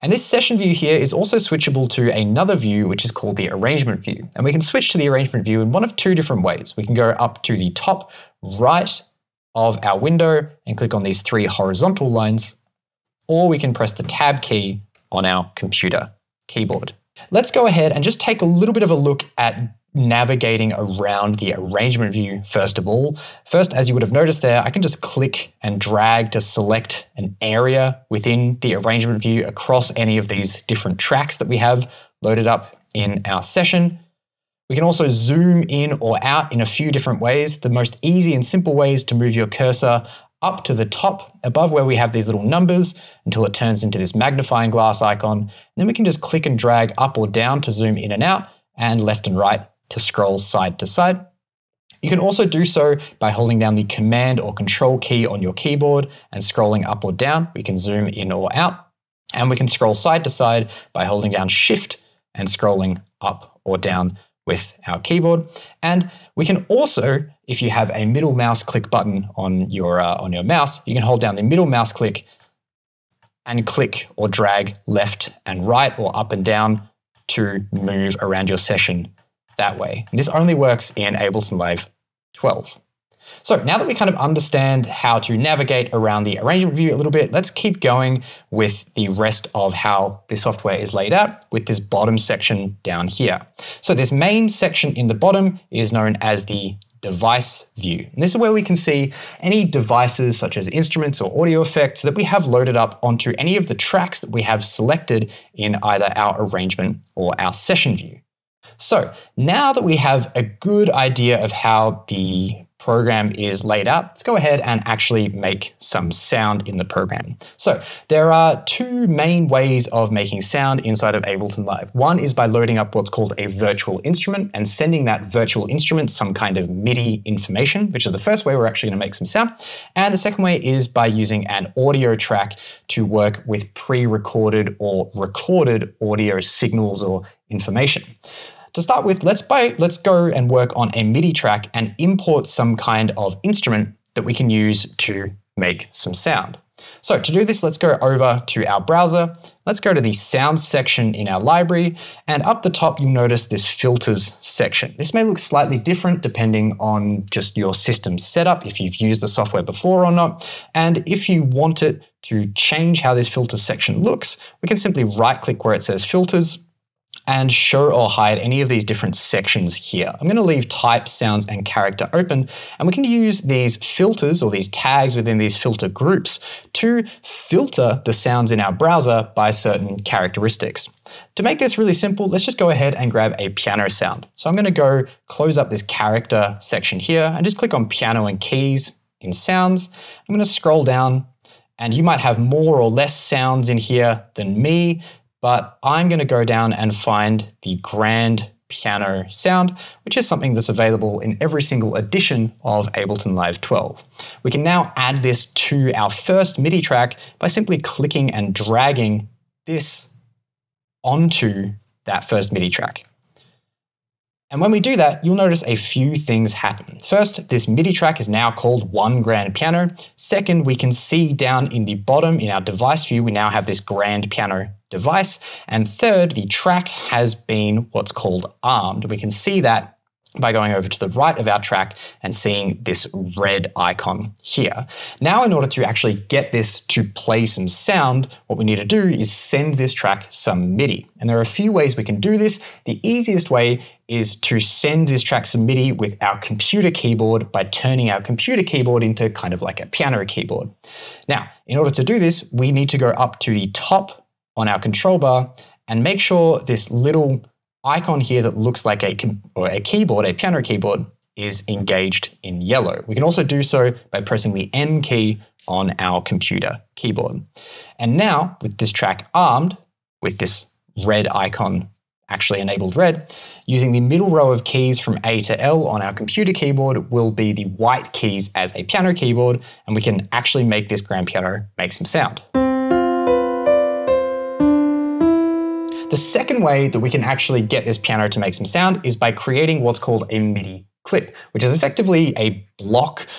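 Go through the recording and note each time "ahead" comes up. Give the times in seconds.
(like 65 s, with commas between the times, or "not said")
17 s, 114 s, 182 s.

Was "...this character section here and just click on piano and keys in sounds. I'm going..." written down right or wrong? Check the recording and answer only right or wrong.
right.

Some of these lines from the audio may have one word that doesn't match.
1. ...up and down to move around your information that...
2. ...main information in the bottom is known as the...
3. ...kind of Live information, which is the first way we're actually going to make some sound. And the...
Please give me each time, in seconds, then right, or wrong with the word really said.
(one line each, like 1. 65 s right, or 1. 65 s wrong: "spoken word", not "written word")
1. 76 s wrong: "session", not "information"
2. 94 s wrong: "section", not "information"
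3. 126 s wrong: "MIDI", not "Live".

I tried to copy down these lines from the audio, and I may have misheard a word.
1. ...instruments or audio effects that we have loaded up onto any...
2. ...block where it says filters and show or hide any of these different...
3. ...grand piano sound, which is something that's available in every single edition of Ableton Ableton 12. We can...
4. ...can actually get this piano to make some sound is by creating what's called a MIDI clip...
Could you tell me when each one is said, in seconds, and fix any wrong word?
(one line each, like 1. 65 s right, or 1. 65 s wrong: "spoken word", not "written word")
1. 100 s right
2. 165 s wrong: "click", not "block"
3. 197 s wrong: "Live", not "Ableton"
4. 287 s right.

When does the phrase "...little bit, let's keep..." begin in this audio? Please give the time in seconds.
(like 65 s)
86 s.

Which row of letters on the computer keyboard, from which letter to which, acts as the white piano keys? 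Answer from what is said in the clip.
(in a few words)
A to L.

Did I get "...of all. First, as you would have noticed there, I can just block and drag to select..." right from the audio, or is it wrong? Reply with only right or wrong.
wrong.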